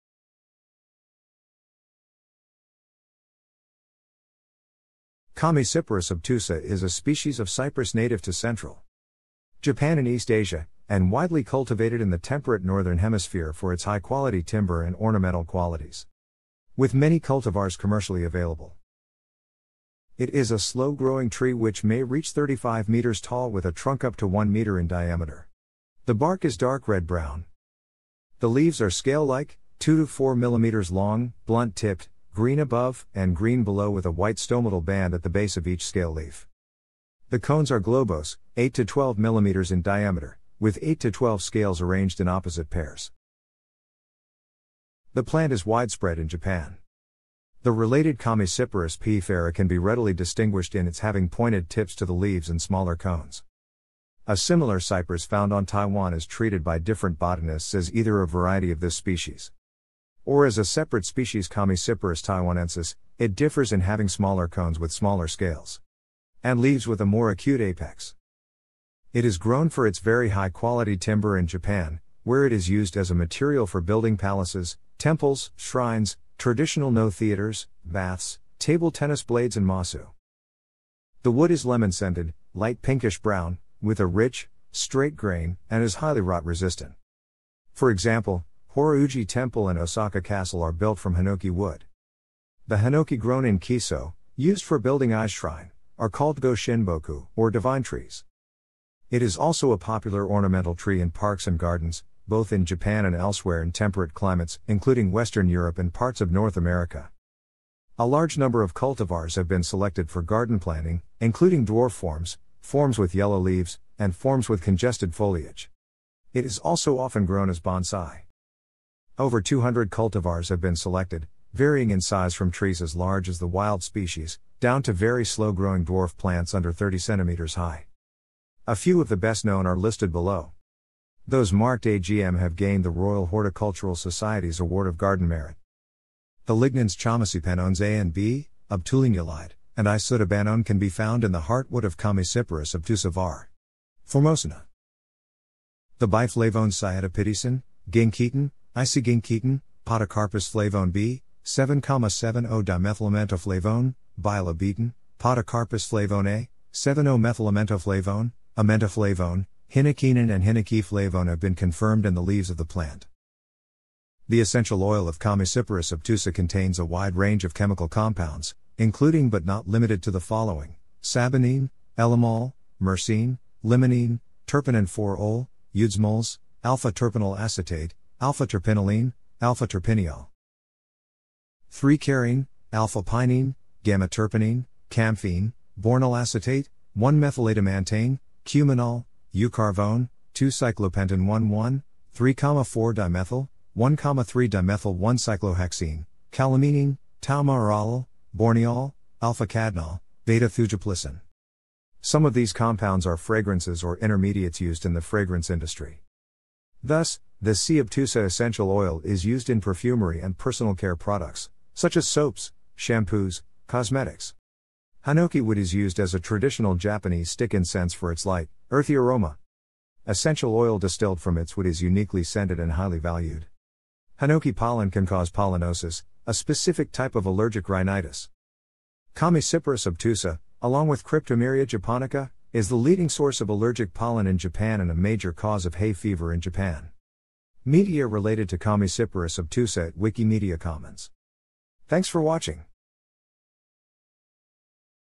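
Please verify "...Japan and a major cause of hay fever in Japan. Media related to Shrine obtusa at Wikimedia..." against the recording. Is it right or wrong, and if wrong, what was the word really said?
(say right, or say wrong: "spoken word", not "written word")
wrong: "Chamaecyparis", not "Shrine".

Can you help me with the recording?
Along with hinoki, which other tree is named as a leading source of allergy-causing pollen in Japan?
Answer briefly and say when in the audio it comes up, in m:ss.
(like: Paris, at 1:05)
Cryptomeria japonica, at 3:51.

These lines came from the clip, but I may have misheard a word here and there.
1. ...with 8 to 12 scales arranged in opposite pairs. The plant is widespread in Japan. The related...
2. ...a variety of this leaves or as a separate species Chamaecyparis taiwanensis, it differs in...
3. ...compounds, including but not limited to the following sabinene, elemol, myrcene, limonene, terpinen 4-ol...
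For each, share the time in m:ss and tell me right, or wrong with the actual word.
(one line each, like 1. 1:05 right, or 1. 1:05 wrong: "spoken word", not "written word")
1. 0:40 right
2. 0:58 wrong: "species", not "leaves"
3. 2:47 right.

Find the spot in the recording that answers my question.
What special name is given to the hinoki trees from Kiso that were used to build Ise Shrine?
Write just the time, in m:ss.
1:36.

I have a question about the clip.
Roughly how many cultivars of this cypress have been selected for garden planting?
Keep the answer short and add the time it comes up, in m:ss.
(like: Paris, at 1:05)
Over 200, at 1:59.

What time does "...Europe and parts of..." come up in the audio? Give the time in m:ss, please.
1:45.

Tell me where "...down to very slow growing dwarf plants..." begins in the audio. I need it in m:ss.
2:04.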